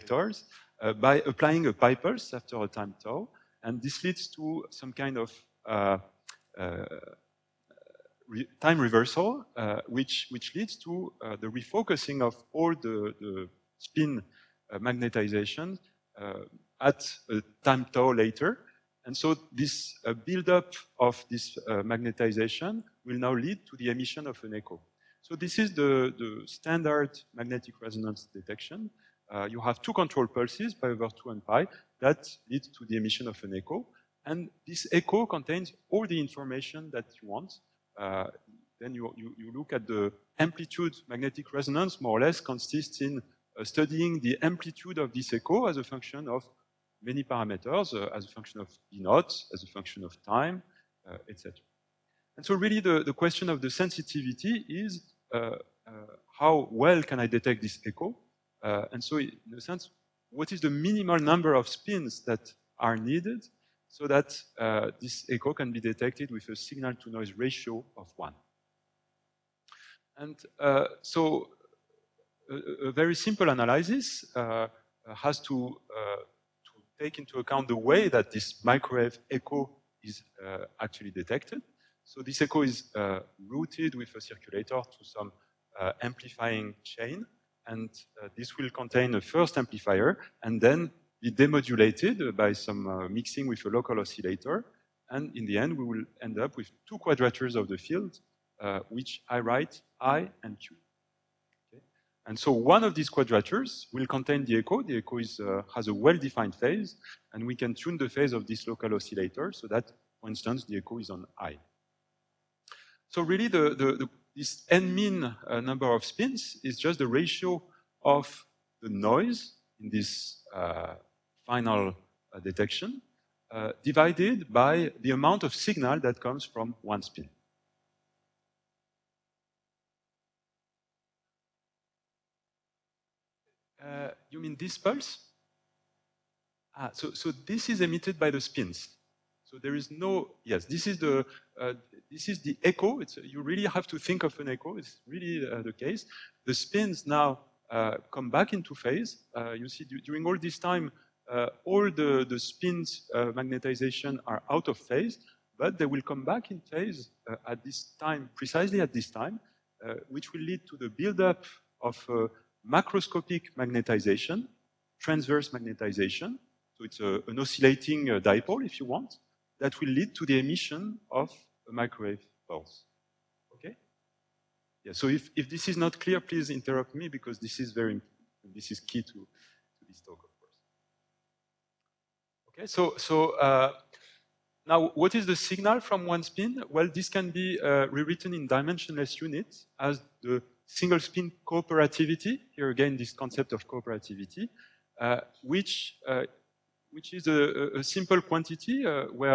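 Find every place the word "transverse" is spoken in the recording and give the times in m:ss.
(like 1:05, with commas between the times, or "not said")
2:44.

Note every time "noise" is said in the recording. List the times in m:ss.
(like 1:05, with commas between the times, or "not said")
1:06, 1:58.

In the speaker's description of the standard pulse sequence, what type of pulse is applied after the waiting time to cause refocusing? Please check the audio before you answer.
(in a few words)
pi pulse.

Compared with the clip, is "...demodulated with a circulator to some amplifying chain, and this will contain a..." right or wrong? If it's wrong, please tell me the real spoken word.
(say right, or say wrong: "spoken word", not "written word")
wrong: "routed", not "demodulated".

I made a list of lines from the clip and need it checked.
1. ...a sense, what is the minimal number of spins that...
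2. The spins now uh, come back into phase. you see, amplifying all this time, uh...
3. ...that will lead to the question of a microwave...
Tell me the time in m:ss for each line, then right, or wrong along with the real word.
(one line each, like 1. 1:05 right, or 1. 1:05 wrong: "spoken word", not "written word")
1. 0:59 right
2. 2:26 wrong: "during", not "amplifying"
3. 2:49 wrong: "emission", not "question".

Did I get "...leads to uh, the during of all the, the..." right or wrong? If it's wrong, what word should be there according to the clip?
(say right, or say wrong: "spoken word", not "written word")
wrong: "refocusing", not "during".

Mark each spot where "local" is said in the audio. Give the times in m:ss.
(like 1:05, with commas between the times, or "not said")
1:33, 1:48.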